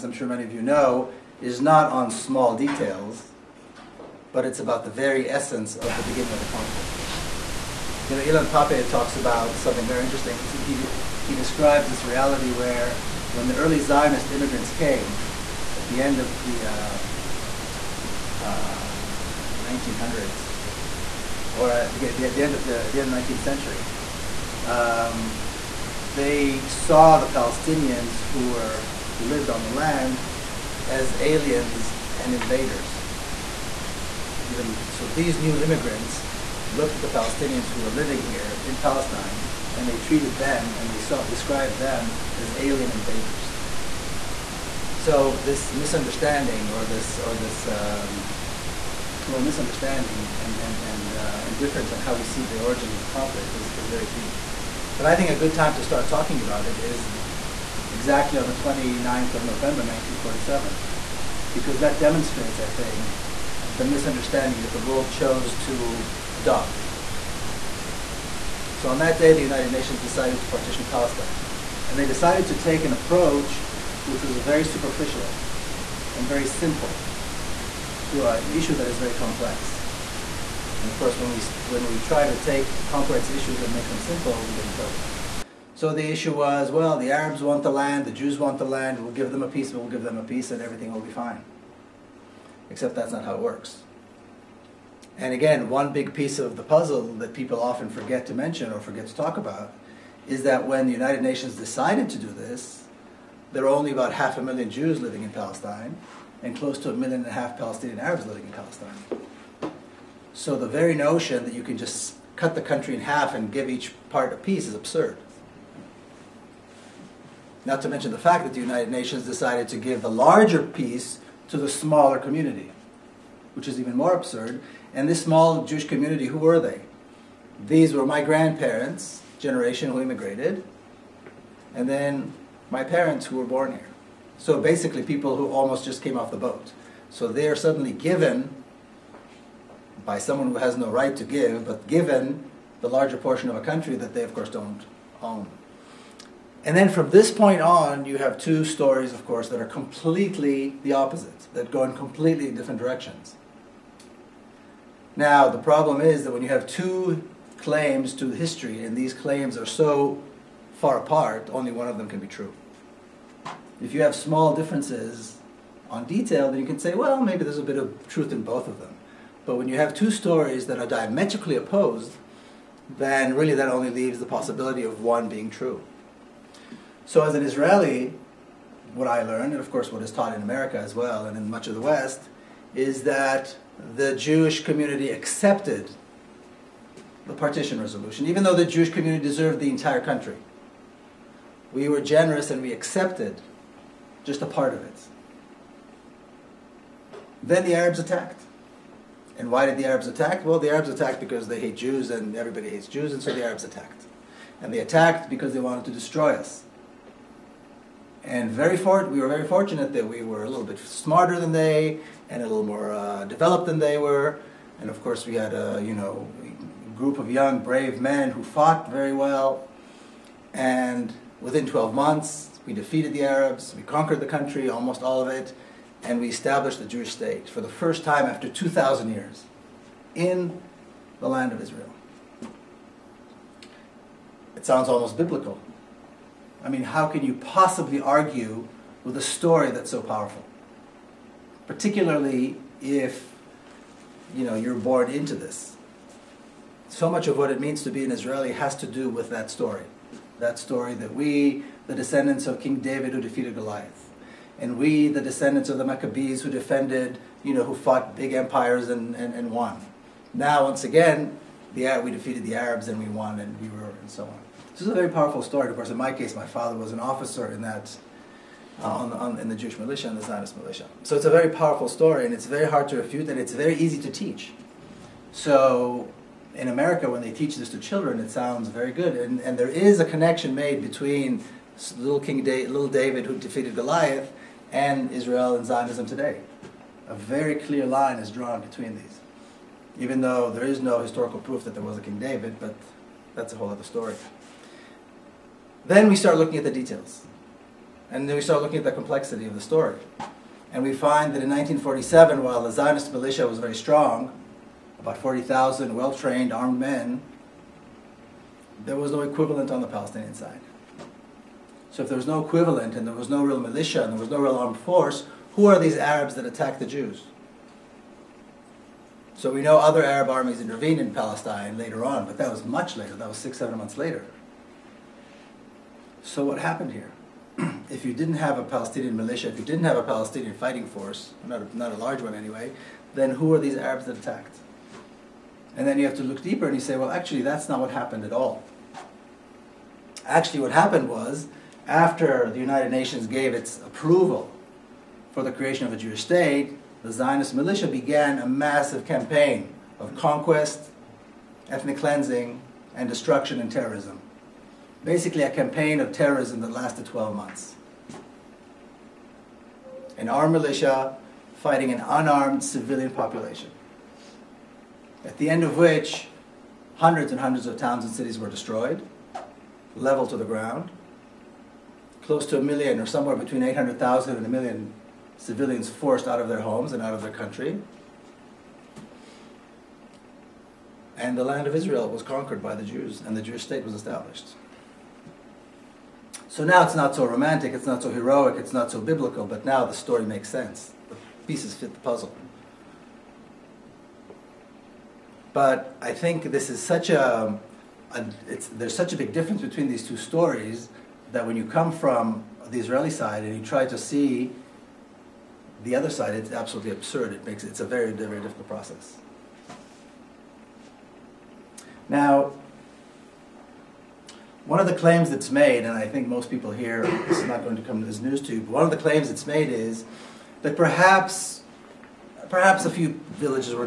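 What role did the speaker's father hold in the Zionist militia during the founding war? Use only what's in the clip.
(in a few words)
officer.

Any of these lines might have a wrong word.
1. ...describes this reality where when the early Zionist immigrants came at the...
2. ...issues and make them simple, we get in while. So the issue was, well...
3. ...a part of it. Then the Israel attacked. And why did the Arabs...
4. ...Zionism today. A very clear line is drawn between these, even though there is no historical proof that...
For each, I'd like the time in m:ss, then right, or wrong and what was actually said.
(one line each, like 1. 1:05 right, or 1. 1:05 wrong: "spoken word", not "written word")
1. 0:11 right
2. 1:23 wrong: "trouble", not "while"
3. 3:14 wrong: "Arabs", not "Israel"
4. 4:45 right.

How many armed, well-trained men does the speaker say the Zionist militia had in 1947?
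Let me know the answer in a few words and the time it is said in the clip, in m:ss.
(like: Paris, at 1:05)
40,000, at 5:05.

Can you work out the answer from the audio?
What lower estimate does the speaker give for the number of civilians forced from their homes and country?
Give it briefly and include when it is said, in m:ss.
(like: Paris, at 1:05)
800,000, at 6:13.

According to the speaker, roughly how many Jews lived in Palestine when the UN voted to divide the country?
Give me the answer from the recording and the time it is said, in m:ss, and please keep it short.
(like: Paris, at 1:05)
half a million, at 1:44.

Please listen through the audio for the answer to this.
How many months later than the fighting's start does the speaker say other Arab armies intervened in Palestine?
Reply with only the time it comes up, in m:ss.
5:23.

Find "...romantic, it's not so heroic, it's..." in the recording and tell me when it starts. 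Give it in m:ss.
6:27.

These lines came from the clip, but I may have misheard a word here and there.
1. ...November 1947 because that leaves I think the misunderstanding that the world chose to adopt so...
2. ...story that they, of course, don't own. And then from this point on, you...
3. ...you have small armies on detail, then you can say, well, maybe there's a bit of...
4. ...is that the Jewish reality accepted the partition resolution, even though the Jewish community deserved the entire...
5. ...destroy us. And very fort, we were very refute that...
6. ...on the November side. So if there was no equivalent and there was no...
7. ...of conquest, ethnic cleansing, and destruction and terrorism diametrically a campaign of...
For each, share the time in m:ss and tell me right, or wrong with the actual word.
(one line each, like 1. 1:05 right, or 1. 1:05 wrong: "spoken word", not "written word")
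1. 0:59 wrong: "demonstrates", not "leaves"
2. 2:23 wrong: "country", not "story"
3. 2:43 wrong: "differences", not "armies"
4. 3:02 wrong: "community", not "reality"
5. 3:25 wrong: "fortunate", not "refute"
6. 5:09 wrong: "Palestinian", not "November"
7. 5:49 wrong: "basically", not "diametrically".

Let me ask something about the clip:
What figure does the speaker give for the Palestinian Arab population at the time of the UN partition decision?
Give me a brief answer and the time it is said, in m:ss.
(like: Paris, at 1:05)
1.5 million, at 1:46.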